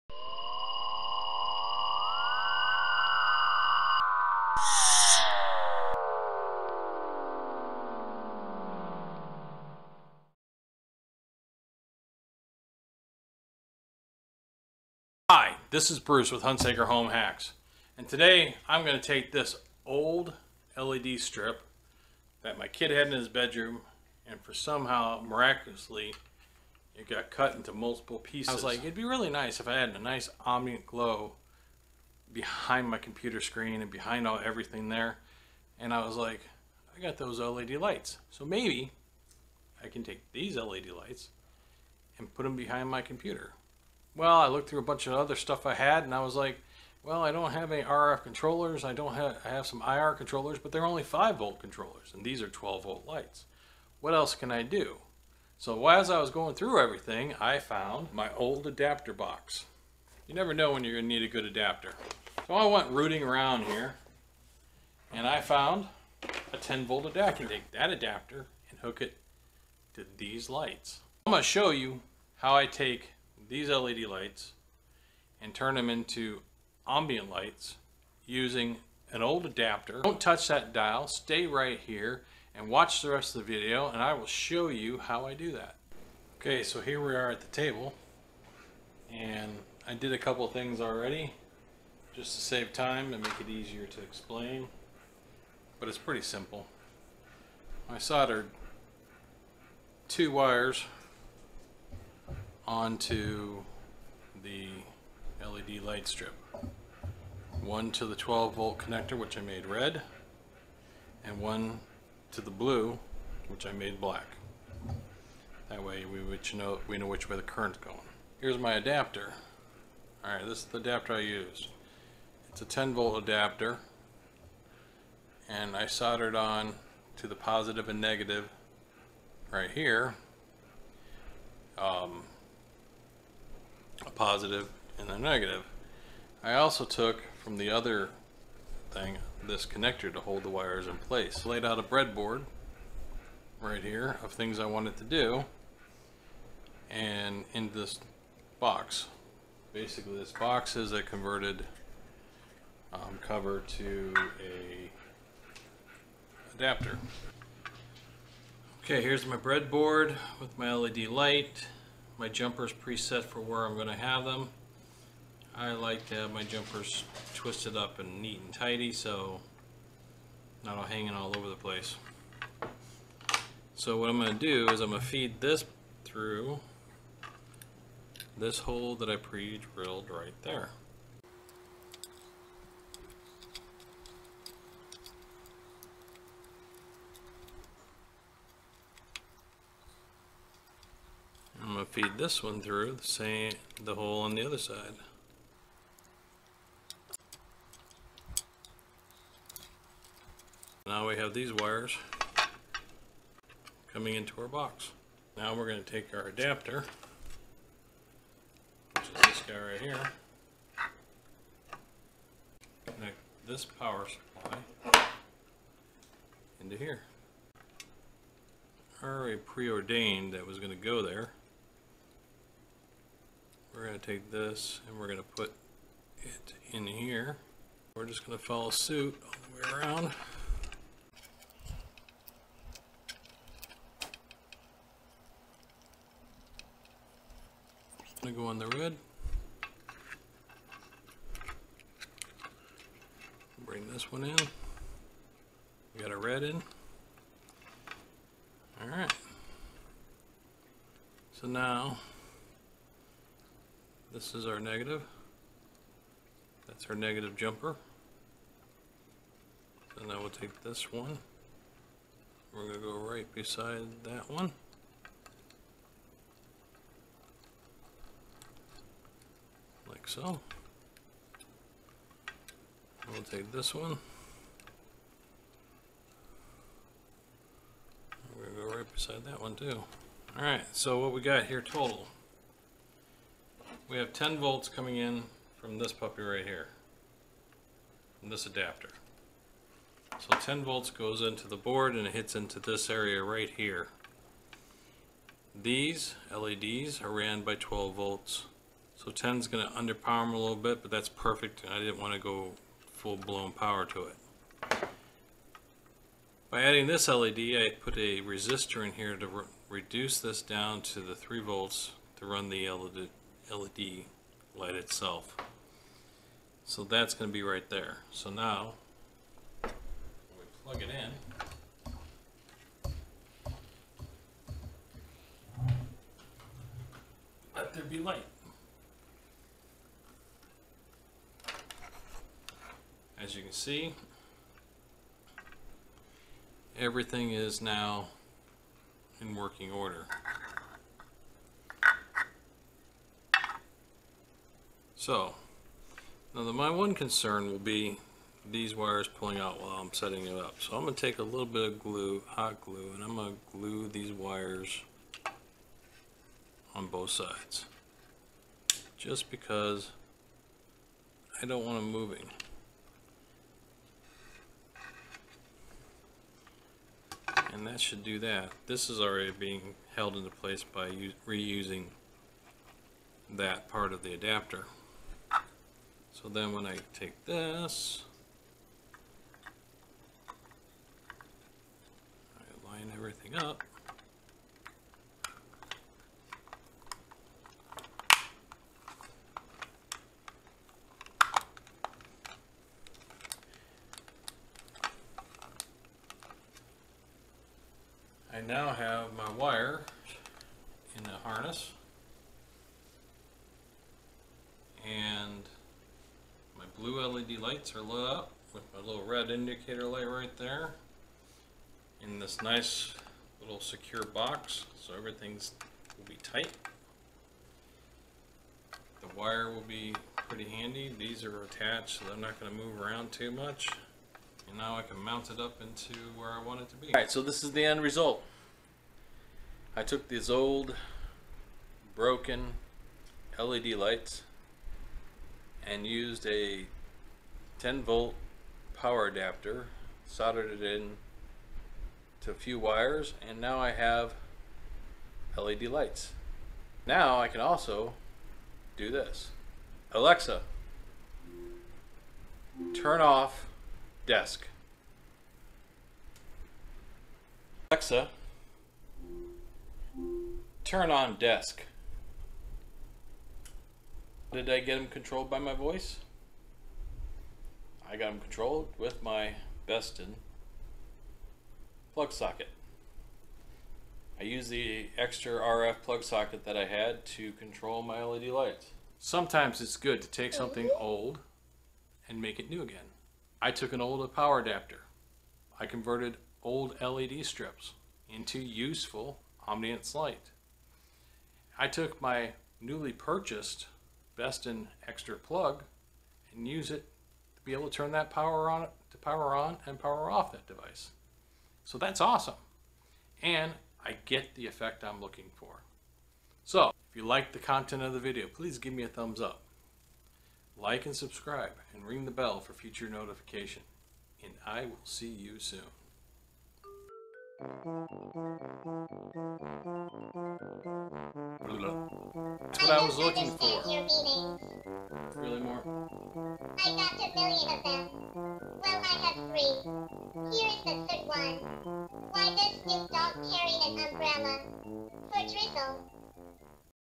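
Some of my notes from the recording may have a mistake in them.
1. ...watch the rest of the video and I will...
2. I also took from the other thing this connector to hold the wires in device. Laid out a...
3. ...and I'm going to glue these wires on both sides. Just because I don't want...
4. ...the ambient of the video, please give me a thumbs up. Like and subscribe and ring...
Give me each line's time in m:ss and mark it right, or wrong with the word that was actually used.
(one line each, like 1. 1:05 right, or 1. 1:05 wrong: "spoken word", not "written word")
1. 1:22 right
2. 2:16 wrong: "place", not "device"
3. 5:52 right
4. 8:27 wrong: "content", not "ambient".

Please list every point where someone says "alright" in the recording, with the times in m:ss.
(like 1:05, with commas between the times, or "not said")
4:40, 7:06.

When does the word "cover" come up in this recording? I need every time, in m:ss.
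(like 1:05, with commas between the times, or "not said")
2:33.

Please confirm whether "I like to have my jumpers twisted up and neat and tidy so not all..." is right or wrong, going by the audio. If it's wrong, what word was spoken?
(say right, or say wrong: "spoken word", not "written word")
right.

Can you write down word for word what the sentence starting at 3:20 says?
Now we have these wires coming into our box.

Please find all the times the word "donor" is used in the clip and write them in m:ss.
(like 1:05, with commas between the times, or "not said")
not said.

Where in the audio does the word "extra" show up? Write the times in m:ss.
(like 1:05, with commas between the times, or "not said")
7:54, 8:14.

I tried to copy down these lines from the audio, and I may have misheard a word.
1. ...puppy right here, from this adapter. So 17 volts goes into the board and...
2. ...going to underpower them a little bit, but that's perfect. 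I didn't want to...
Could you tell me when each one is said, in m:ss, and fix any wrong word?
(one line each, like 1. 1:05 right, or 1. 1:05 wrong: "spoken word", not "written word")
1. 4:45 wrong: "10", not "17"
2. 4:59 right.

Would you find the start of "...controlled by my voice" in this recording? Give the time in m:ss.
7:44.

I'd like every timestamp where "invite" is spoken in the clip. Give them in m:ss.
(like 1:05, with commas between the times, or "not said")
not said.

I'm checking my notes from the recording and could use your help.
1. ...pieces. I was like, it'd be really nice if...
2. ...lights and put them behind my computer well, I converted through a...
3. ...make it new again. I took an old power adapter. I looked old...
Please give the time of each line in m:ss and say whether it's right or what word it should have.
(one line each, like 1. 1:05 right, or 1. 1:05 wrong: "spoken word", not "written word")
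1. 0:28 right
2. 0:40 wrong: "looked", not "converted"
3. 8:02 wrong: "converted", not "looked".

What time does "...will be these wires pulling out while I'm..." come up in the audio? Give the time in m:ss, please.
5:47.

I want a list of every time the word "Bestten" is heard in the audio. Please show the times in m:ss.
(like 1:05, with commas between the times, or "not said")
7:49, 8:14.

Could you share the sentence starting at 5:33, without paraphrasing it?
As you can see, everything is now in working order.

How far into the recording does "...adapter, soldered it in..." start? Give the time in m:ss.
7:19.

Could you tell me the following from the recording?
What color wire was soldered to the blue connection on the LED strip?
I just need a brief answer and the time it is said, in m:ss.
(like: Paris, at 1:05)
black, at 1:53.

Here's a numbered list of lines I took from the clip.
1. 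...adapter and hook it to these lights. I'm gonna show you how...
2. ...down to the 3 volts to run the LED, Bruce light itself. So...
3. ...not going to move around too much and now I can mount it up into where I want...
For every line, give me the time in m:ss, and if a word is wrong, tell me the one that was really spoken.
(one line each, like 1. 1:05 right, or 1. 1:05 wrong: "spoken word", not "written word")
1. 1:07 right
2. 5:10 wrong: "LED", not "Bruce"
3. 7:02 right.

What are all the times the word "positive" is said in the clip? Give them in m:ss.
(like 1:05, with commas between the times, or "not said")
2:07, 2:14.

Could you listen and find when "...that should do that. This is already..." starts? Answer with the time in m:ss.
6:07.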